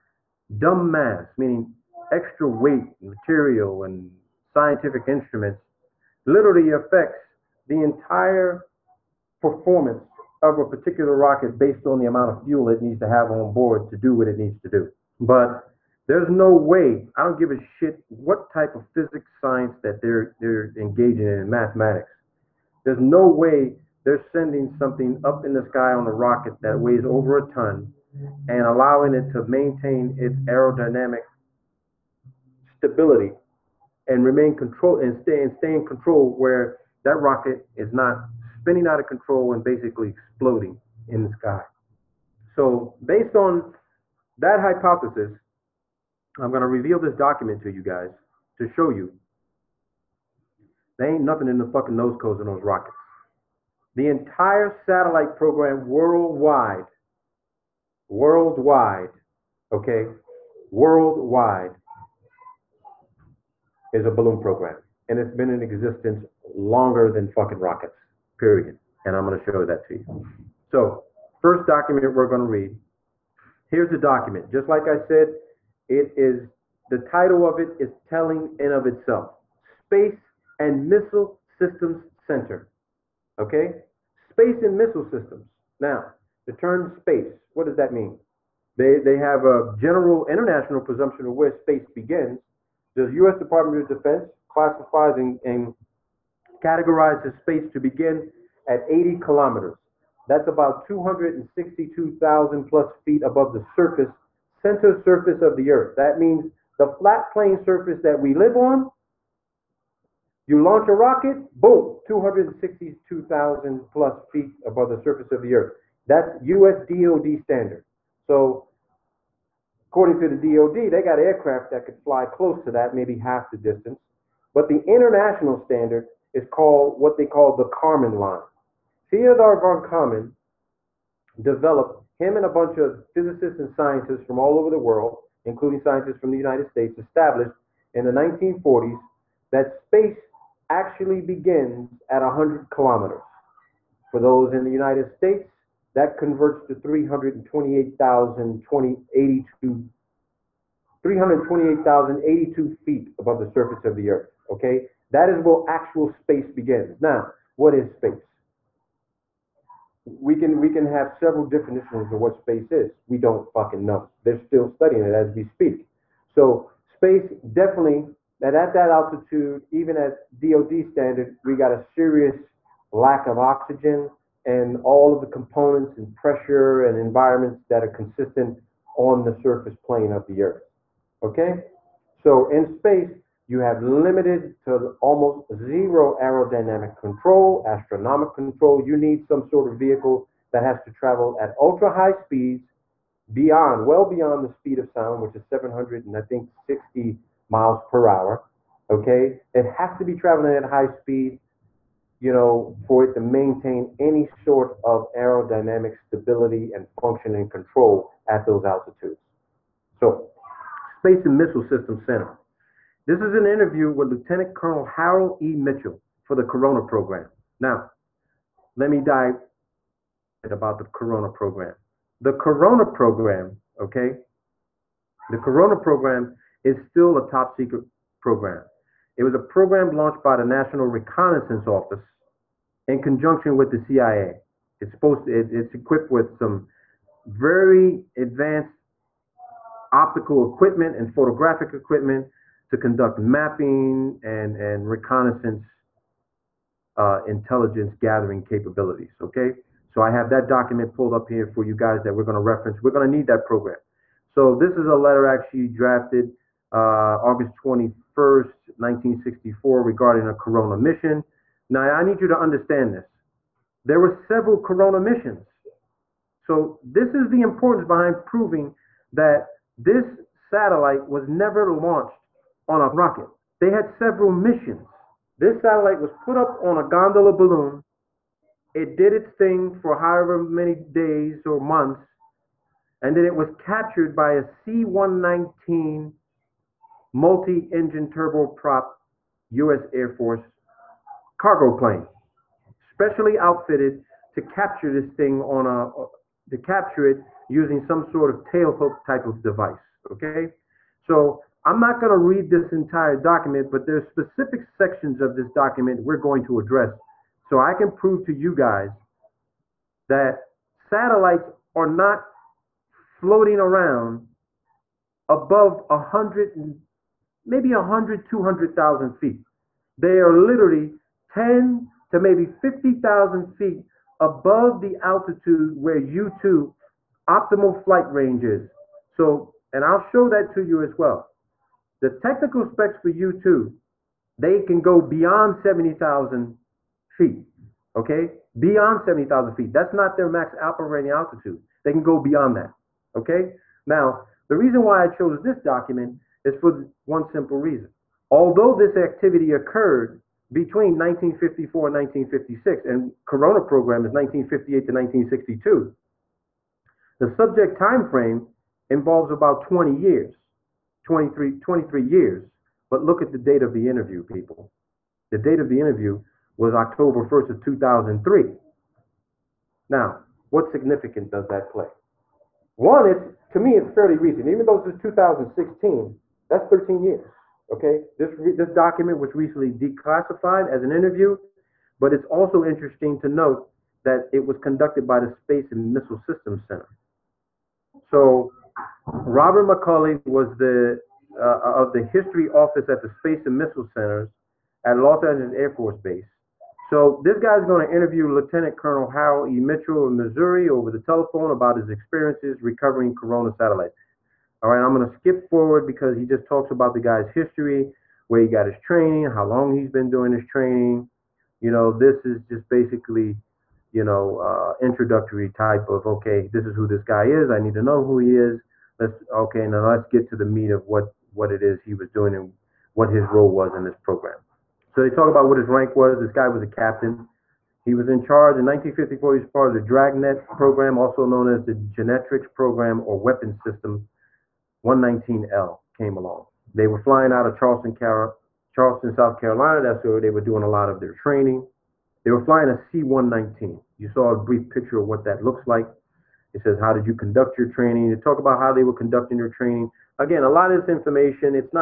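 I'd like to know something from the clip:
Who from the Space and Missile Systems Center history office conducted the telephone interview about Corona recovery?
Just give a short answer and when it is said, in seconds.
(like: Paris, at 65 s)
Robert McCulley, at 389 s.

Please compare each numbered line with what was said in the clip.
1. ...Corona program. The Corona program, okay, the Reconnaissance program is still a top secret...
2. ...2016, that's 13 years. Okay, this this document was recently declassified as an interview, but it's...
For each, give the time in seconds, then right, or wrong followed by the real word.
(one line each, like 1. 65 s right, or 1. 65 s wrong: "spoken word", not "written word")
1. 220 s wrong: "Corona", not "Reconnaissance"
2. 374 s right.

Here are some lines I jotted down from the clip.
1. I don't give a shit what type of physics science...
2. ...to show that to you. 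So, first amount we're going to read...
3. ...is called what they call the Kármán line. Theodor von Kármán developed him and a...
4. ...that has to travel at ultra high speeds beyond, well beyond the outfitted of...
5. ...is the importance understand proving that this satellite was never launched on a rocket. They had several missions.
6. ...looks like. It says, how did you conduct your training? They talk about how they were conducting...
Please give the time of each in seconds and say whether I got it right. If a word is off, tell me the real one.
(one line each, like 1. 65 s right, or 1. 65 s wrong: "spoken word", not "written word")
1. 17 s right
2. 69 s wrong: "document", not "amount"
3. 126 s right
4. 190 s wrong: "speed", not "outfitted"
5. 267 s wrong: "behind", not "understand"
6. 445 s right.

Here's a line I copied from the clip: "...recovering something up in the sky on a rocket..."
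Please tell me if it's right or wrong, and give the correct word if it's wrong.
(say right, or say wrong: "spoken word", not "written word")
wrong: "sending", not "recovering".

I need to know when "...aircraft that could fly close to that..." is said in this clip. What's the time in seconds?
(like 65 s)
121 s.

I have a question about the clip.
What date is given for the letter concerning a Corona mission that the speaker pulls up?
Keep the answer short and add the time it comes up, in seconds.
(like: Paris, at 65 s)
August 21st, 1964, at 257 s.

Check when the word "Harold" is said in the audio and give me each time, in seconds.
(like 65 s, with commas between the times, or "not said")
214 s, 399 s.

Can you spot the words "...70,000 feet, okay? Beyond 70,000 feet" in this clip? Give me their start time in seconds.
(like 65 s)
335 s.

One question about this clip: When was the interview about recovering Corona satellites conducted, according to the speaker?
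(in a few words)
October 1st, 2003.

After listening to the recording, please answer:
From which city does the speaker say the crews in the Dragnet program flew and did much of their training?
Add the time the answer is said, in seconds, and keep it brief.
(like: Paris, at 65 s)
Charleston, South Carolina, at 438 s.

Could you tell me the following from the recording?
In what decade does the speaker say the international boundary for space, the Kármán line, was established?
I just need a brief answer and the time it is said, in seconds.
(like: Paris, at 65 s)
1940s, at 138 s.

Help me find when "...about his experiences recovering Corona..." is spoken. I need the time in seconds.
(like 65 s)
401 s.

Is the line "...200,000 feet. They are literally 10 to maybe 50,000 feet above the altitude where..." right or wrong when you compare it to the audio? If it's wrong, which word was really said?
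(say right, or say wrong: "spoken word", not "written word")
right.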